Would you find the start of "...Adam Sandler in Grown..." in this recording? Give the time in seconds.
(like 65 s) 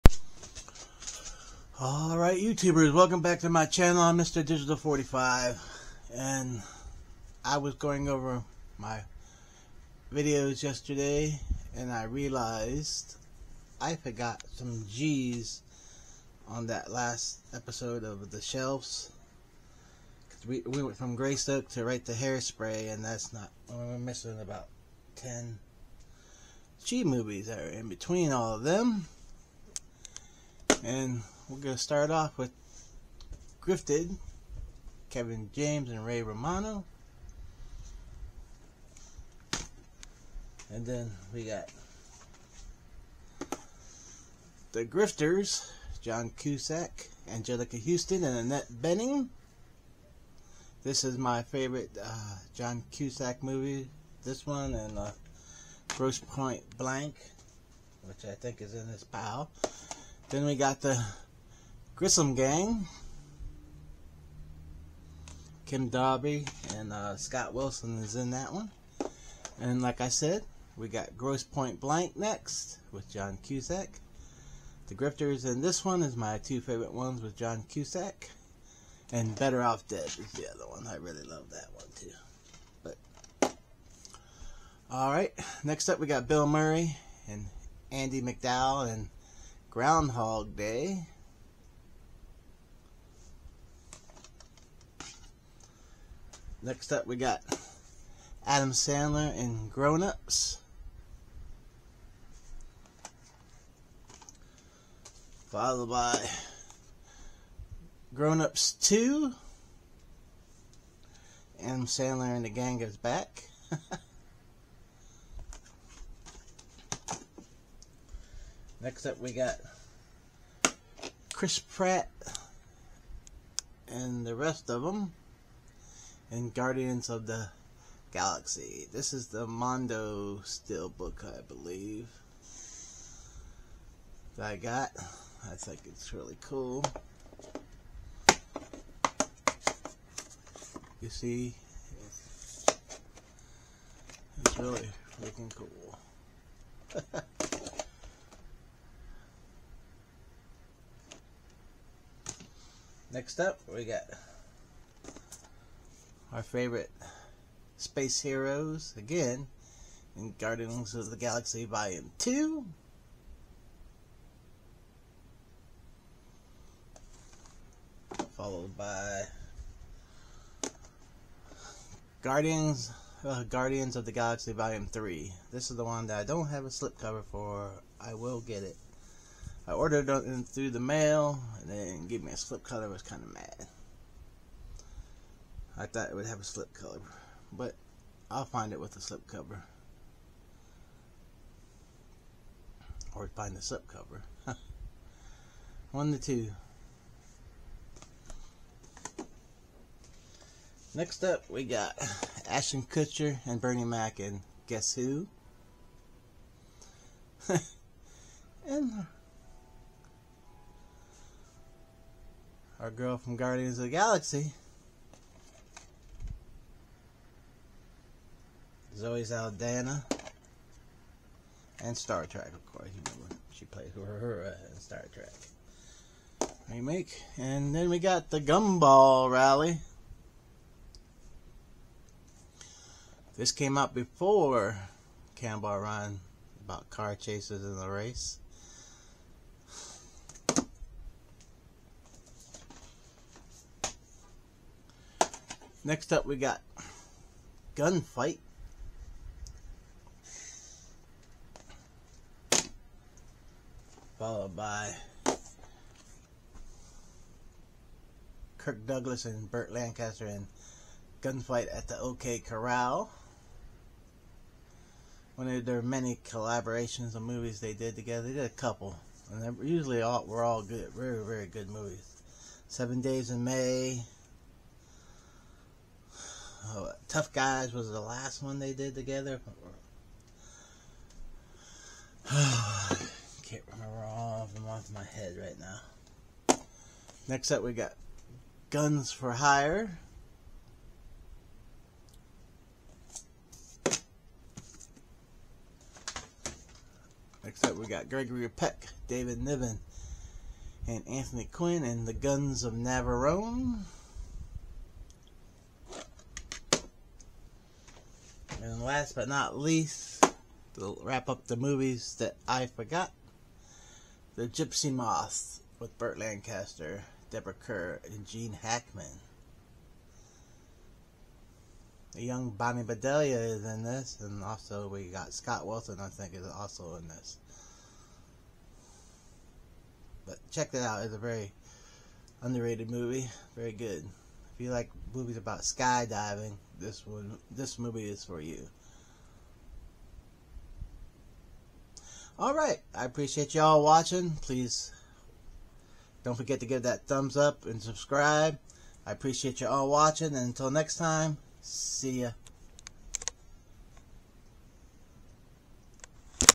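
98 s.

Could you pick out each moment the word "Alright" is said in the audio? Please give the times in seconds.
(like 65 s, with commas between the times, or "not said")
1 s, 84 s.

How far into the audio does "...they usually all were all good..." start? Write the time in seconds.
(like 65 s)
269 s.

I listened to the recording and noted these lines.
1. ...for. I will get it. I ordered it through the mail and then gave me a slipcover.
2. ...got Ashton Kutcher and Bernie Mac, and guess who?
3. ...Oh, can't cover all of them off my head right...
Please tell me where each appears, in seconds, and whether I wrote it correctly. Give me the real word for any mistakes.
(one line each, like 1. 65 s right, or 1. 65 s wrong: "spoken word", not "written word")
1. 177 s right
2. 201 s right
3. 282 s wrong: "remember", not "cover".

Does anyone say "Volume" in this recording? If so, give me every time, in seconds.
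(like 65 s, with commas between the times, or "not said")
161 s, 174 s.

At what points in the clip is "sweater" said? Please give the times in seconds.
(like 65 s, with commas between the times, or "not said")
not said.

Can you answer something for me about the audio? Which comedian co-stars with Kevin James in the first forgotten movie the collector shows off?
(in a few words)
Ray Romano.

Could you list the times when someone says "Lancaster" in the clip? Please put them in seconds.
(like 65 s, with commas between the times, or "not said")
259 s, 316 s.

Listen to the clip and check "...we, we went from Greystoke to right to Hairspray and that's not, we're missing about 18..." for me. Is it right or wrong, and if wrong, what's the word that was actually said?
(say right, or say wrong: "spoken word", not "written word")
wrong: "10", not "18".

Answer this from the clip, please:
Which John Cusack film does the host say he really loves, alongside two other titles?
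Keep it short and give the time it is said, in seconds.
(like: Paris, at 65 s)
Better Off Dead, at 79 s.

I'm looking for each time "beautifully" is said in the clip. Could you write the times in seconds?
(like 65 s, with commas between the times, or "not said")
not said.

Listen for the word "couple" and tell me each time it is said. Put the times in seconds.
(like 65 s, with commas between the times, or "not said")
268 s.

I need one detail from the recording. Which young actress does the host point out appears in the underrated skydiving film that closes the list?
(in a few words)
Bonnie Bedelia.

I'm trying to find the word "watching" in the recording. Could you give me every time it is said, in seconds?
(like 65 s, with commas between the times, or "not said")
343 s, 349 s.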